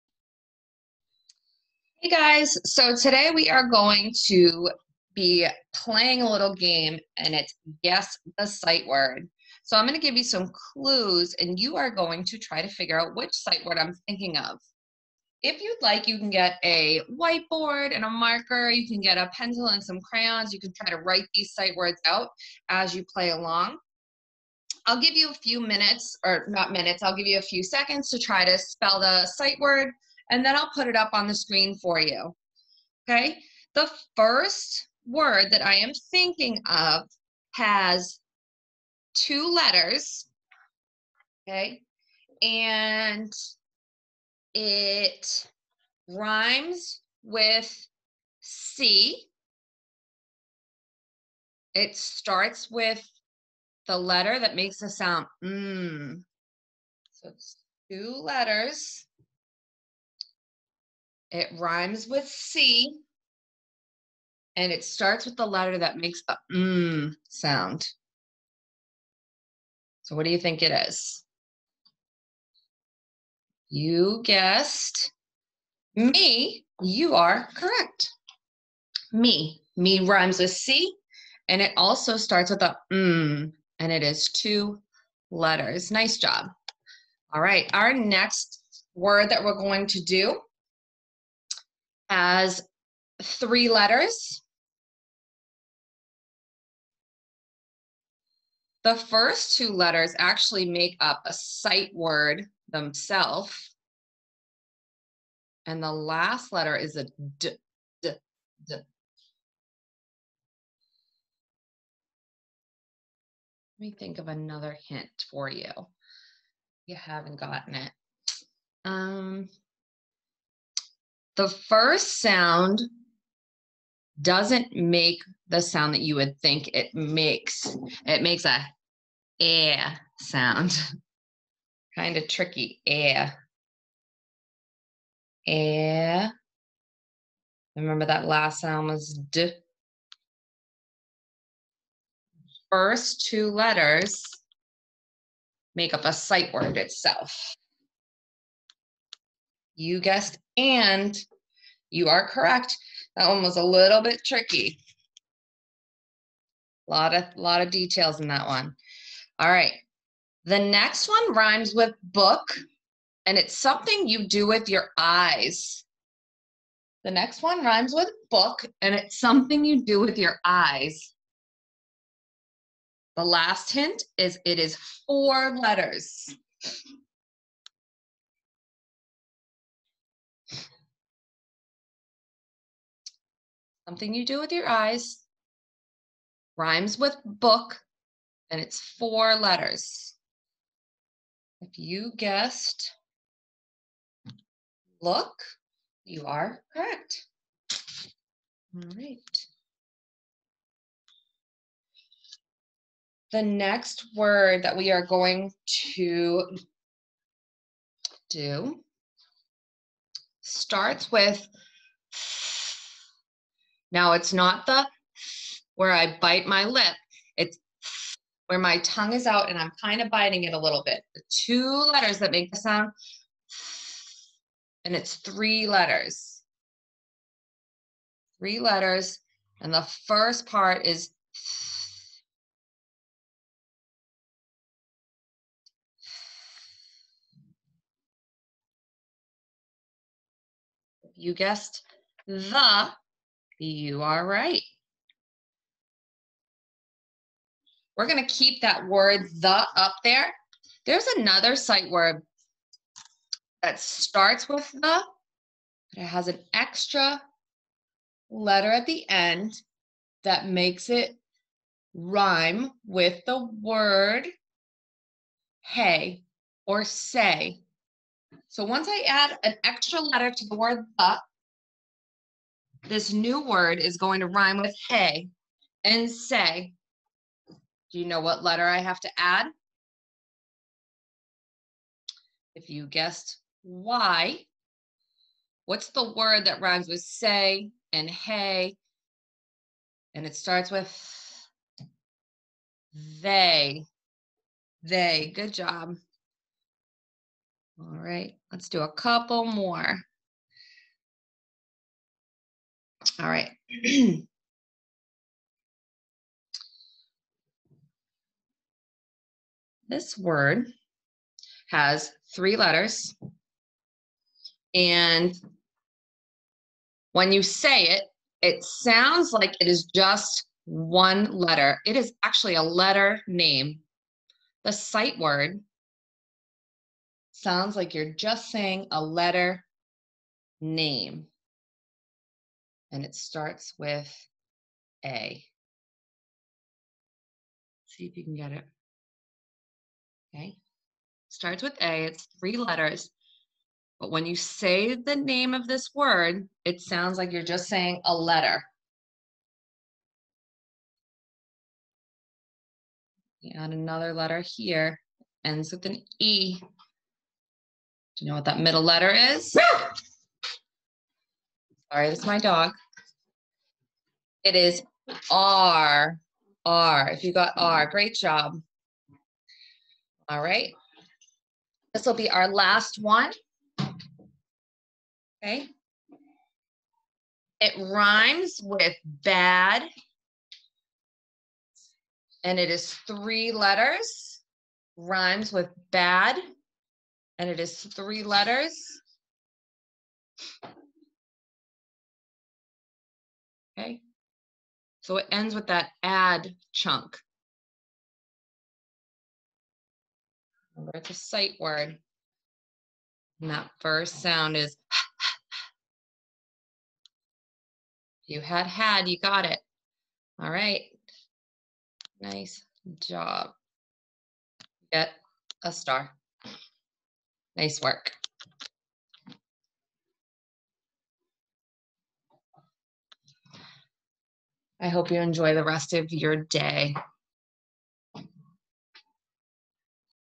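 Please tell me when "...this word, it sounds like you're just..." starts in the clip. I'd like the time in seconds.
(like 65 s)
345 s.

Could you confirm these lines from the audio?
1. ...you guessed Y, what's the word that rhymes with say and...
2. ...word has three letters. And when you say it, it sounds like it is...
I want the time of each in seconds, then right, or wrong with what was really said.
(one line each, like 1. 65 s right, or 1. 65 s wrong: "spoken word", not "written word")
1. 282 s right
2. 310 s right.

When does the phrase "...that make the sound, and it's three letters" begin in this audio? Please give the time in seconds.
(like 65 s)
222 s.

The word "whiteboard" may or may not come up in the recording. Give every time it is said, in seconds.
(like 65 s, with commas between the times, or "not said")
17 s.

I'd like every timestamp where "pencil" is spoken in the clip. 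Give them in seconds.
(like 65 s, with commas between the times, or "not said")
19 s.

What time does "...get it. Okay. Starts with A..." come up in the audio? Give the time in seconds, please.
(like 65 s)
338 s.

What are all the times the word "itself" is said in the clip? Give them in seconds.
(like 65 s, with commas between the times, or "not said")
146 s.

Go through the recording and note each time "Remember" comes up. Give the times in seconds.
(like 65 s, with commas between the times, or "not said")
137 s, 400 s.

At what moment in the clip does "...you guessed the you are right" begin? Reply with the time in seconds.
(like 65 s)
241 s.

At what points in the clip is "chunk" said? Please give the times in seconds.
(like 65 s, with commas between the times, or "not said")
396 s.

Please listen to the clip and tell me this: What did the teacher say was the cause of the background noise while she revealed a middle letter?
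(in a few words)
my dog.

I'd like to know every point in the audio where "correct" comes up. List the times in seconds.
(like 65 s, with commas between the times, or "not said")
77 s, 152 s, 196 s.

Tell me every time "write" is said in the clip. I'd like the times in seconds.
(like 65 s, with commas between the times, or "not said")
21 s.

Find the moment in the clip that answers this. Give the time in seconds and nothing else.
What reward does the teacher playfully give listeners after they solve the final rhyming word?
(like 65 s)
414 s.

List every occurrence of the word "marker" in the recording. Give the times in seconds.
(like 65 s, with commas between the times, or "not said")
18 s.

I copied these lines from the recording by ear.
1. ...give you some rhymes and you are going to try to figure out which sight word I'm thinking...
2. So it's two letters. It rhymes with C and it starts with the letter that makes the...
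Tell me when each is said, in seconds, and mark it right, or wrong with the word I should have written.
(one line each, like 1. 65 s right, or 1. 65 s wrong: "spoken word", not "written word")
1. 10 s wrong: "clues", not "rhymes"
2. 57 s right.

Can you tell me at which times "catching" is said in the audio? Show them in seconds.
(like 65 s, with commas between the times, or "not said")
not said.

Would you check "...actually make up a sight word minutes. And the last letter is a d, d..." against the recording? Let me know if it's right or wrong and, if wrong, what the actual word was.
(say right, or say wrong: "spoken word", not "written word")
wrong: "themselves", not "minutes".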